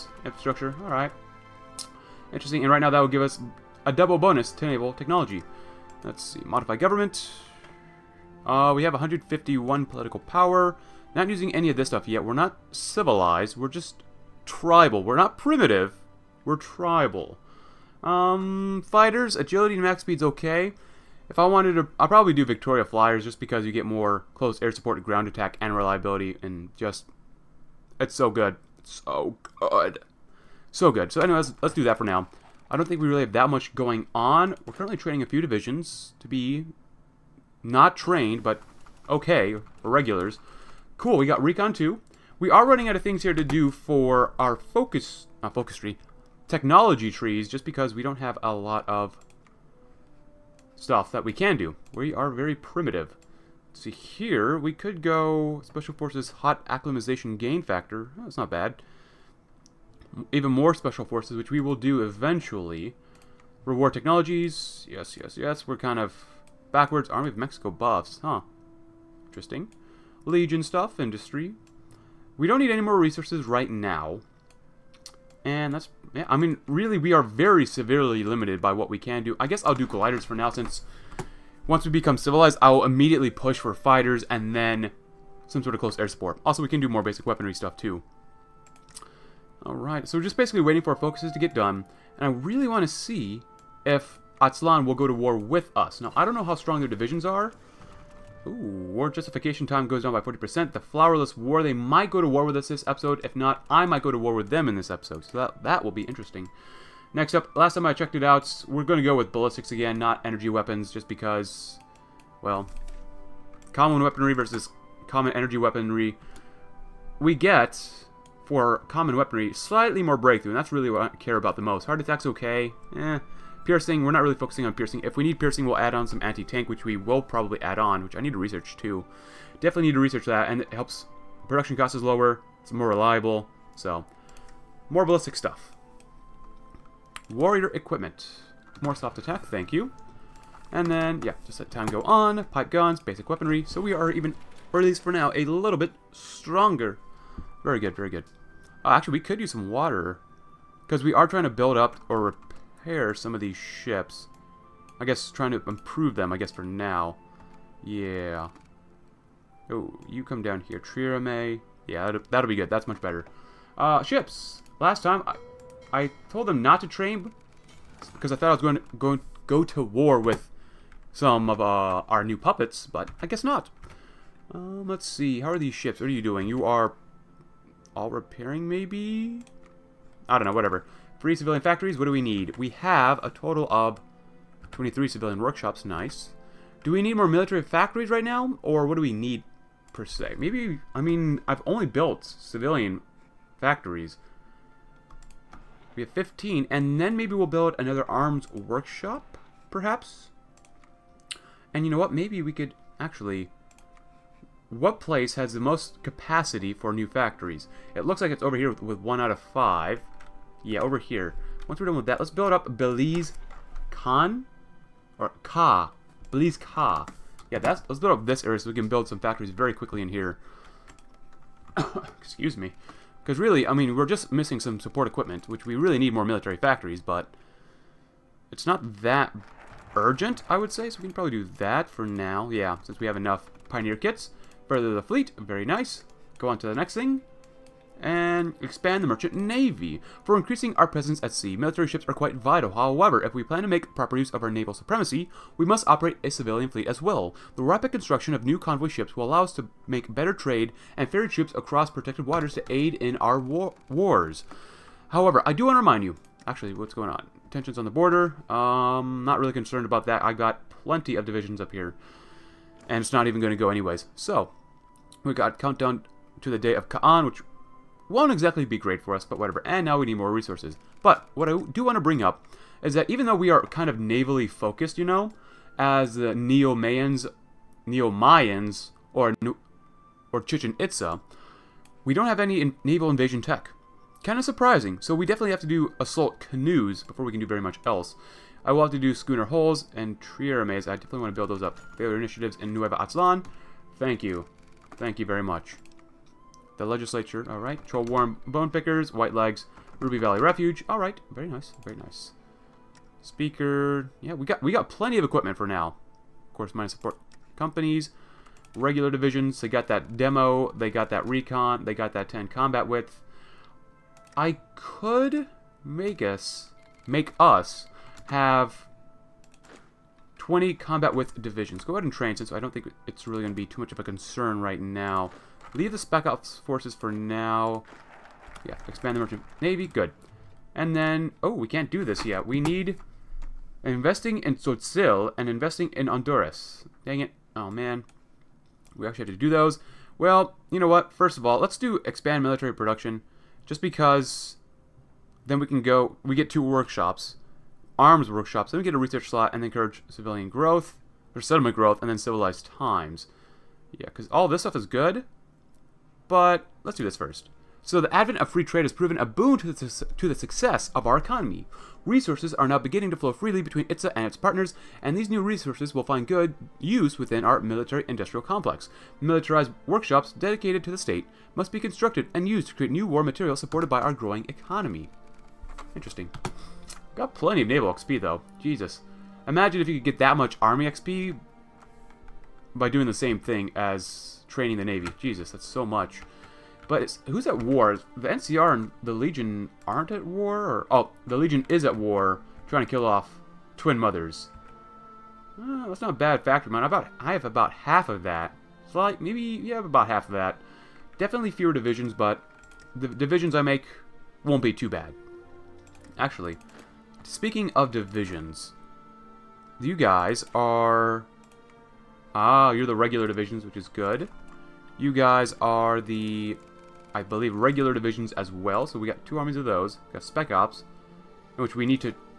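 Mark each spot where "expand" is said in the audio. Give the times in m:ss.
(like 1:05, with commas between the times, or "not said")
3:58, 5:28, 5:42.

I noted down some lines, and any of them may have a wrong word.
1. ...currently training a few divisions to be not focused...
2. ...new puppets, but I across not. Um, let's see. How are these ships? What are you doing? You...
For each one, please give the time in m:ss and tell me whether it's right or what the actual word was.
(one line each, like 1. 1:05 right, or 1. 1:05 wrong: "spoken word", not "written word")
1. 0:34 wrong: "trained", not "focused"
2. 2:52 wrong: "guess", not "across".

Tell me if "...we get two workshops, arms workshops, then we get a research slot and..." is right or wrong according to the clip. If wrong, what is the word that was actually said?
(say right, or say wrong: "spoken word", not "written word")
right.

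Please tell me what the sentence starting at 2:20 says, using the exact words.
And then, yeah, just let time go on.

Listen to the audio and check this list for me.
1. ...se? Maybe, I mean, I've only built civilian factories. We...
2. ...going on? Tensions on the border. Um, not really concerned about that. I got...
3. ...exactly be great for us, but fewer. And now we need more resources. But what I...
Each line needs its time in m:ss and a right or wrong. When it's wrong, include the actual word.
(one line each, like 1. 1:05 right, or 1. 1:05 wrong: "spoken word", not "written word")
1. 3:10 right
2. 4:16 right
3. 4:28 wrong: "whatever", not "fewer".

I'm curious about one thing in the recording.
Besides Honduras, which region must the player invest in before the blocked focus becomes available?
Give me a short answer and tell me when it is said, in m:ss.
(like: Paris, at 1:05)
Tzotzil, at 5:34.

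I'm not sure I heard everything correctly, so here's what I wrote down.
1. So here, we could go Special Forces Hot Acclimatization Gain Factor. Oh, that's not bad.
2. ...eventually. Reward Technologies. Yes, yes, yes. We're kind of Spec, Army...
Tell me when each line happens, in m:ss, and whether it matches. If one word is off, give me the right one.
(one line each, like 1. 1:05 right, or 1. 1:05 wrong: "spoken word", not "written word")
1. 0:53 right
2. 1:02 wrong: "Backwards", not "Spec".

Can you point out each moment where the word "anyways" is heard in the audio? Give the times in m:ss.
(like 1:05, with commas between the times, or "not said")
0:31, 4:23.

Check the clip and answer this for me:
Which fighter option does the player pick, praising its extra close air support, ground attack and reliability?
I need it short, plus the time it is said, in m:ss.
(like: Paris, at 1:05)
Victoria Flyers, at 0:22.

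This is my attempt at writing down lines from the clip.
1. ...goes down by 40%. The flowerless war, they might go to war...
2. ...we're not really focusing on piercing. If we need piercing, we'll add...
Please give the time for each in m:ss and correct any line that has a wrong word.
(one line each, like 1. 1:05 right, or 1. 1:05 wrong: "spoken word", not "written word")
1. 1:39 right
2. 2:04 right.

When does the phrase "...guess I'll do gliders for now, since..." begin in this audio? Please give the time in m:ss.
1:19.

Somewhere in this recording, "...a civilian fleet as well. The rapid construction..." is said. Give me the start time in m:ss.
4:06.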